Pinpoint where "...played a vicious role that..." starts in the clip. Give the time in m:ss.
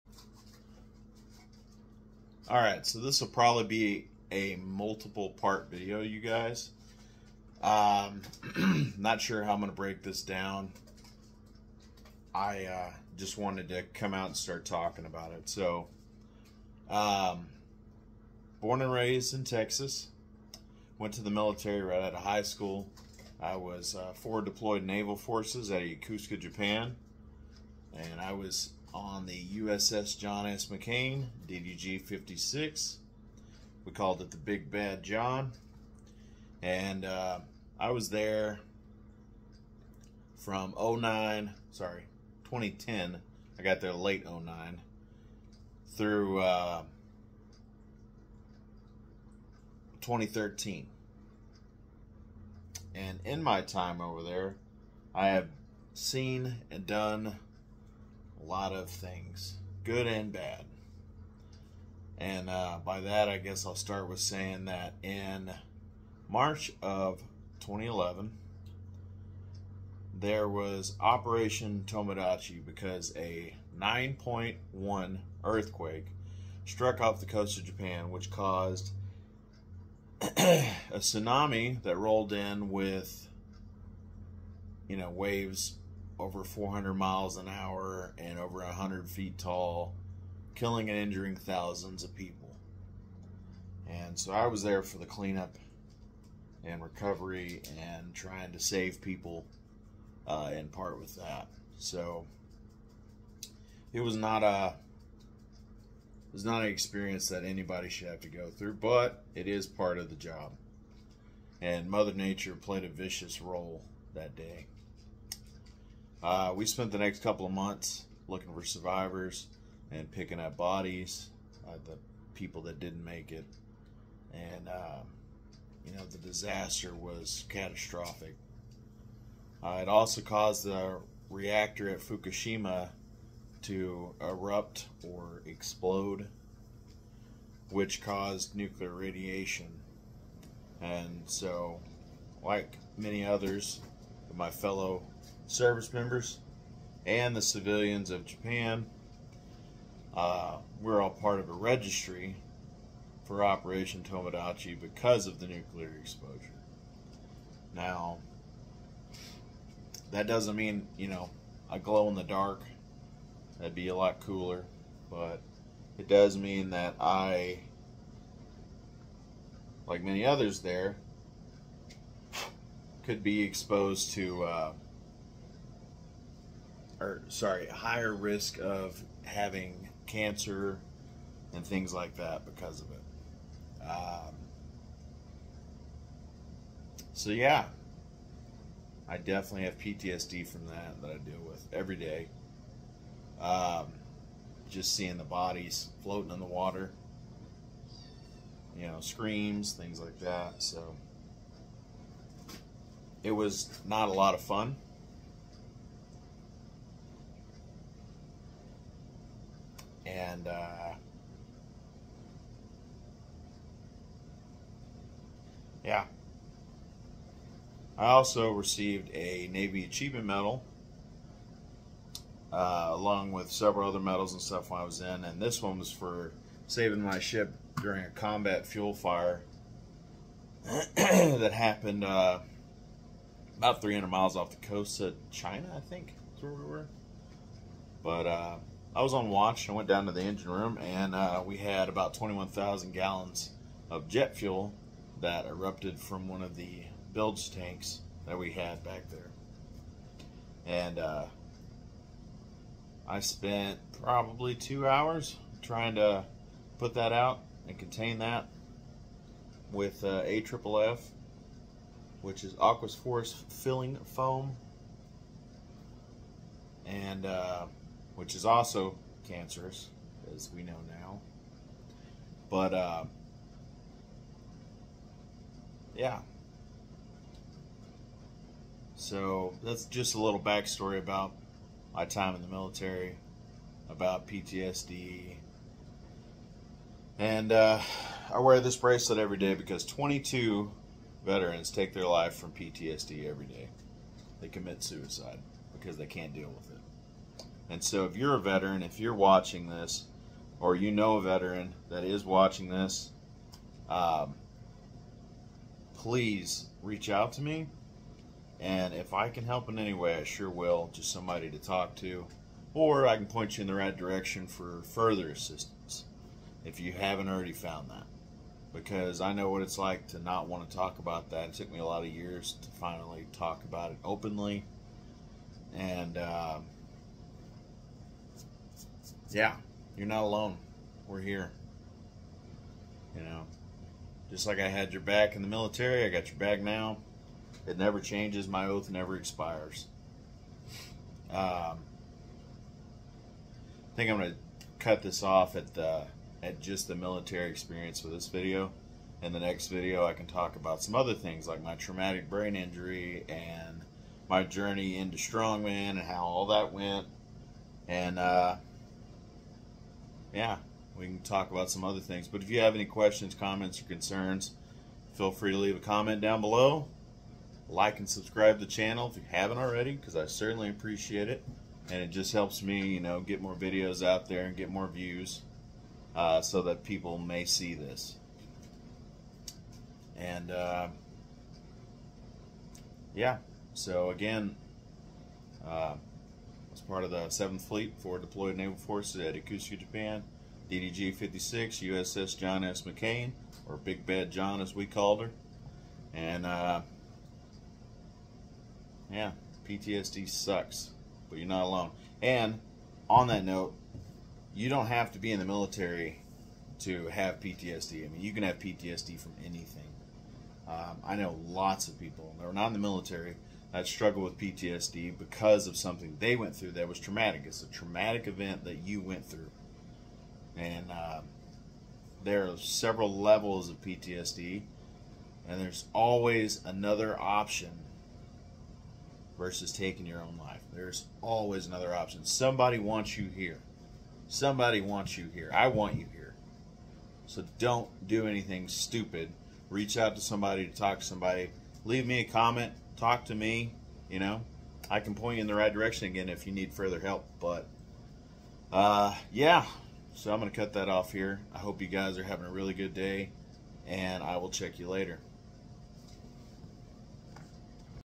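1:52.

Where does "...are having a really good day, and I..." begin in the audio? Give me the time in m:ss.
7:32.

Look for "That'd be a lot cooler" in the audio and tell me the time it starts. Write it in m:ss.
2:43.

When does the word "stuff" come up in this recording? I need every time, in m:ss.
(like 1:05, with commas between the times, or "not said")
3:44.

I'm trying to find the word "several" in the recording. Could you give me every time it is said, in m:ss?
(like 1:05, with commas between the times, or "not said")
3:43, 7:02.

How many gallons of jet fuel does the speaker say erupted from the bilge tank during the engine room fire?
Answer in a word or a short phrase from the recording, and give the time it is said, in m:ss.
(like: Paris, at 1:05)
21,000, at 4:02.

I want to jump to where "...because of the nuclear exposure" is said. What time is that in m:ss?
2:34.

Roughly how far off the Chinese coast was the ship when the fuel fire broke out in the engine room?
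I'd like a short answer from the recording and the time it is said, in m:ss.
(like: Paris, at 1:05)
300 miles, at 3:53.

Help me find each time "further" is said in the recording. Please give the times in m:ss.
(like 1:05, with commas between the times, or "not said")
5:14, 7:26.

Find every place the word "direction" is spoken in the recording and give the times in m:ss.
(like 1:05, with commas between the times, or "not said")
5:13, 7:25.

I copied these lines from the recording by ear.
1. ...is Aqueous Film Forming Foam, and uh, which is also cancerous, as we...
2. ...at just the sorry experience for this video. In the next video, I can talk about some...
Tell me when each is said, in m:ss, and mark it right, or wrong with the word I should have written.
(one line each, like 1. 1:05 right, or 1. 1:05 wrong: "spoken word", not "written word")
1. 4:22 right
2. 5:46 wrong: "military", not "sorry".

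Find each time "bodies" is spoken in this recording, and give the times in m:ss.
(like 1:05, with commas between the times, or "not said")
2:00, 3:15.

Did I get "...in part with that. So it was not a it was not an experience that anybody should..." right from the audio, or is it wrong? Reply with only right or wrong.
right.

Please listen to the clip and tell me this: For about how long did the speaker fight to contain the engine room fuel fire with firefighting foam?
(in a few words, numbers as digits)
2 hours.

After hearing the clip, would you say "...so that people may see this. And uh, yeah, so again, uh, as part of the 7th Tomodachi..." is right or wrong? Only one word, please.
wrong.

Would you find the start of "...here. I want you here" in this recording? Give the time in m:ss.
7:15.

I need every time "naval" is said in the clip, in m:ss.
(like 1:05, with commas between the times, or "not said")
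0:24, 6:28.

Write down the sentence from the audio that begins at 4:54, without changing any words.
They commit suicide because they can't deal with it.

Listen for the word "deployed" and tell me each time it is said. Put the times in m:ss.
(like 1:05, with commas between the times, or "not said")
0:24, 6:28.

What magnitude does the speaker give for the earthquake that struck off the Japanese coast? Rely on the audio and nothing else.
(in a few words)
9.1.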